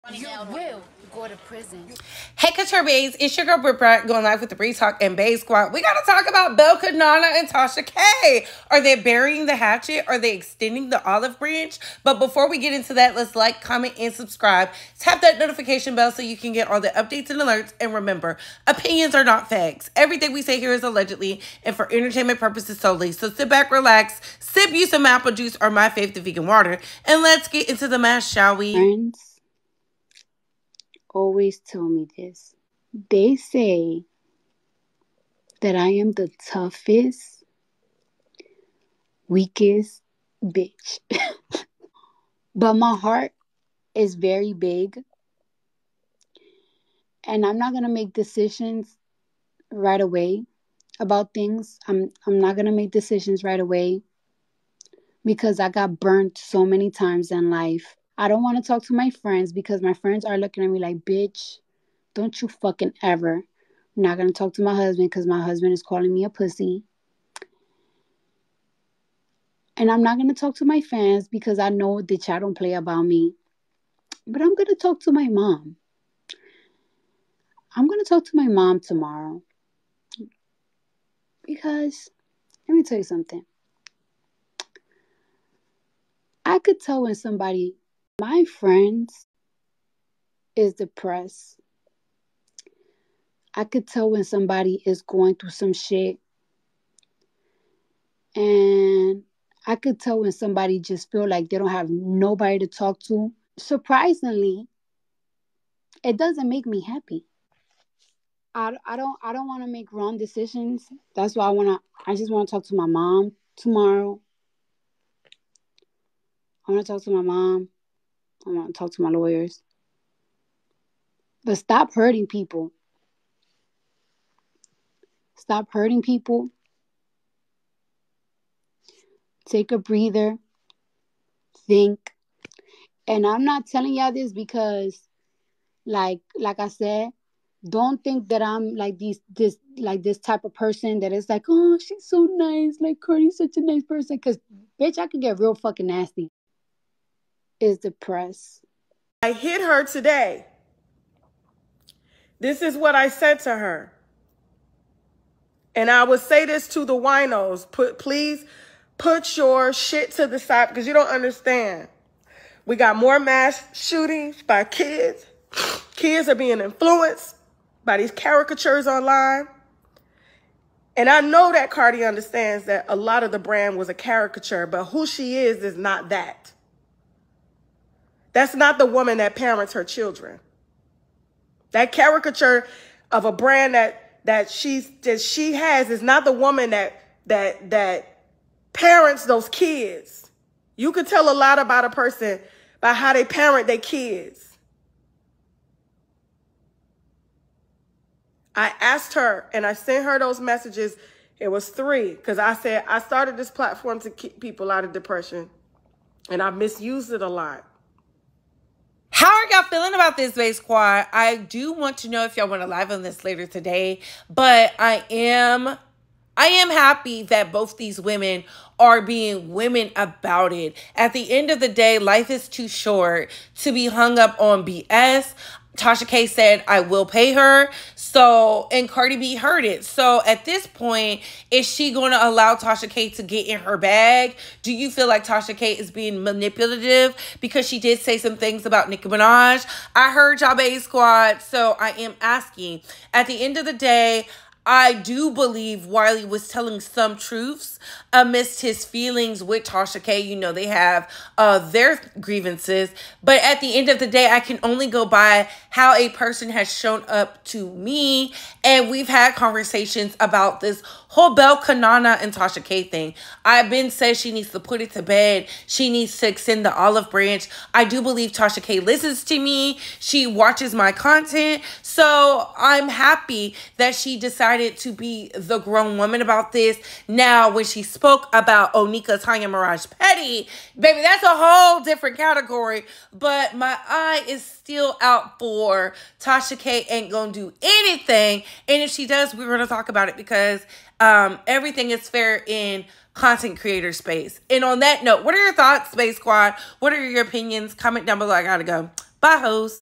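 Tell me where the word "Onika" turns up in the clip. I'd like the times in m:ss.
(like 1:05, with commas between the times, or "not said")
4:38.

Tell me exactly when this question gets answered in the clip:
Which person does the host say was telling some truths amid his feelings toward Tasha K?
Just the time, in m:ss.
4:05.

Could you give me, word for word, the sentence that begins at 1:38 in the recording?
And I could tell when somebody just feel like they don't have nobody to talk to.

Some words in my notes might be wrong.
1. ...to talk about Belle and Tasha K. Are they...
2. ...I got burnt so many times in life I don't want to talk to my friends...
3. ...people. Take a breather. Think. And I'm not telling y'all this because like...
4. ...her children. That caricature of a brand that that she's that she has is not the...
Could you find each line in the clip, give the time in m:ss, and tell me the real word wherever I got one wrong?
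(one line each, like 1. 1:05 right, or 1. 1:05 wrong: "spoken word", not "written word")
1. 0:05 right
2. 0:55 right
3. 2:06 right
4. 2:59 right.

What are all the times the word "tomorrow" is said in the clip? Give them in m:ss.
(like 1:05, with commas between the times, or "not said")
1:18, 1:53.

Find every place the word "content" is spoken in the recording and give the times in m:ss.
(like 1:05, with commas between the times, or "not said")
4:30, 4:53.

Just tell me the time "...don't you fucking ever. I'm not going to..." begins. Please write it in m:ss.
1:02.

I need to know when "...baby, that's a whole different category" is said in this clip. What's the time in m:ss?
4:40.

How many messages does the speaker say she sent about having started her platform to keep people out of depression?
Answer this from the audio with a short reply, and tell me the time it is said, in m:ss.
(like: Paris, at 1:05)
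3, at 3:21.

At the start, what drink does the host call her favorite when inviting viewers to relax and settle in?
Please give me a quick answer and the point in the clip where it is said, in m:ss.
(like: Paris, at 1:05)
vegan water, at 0:26.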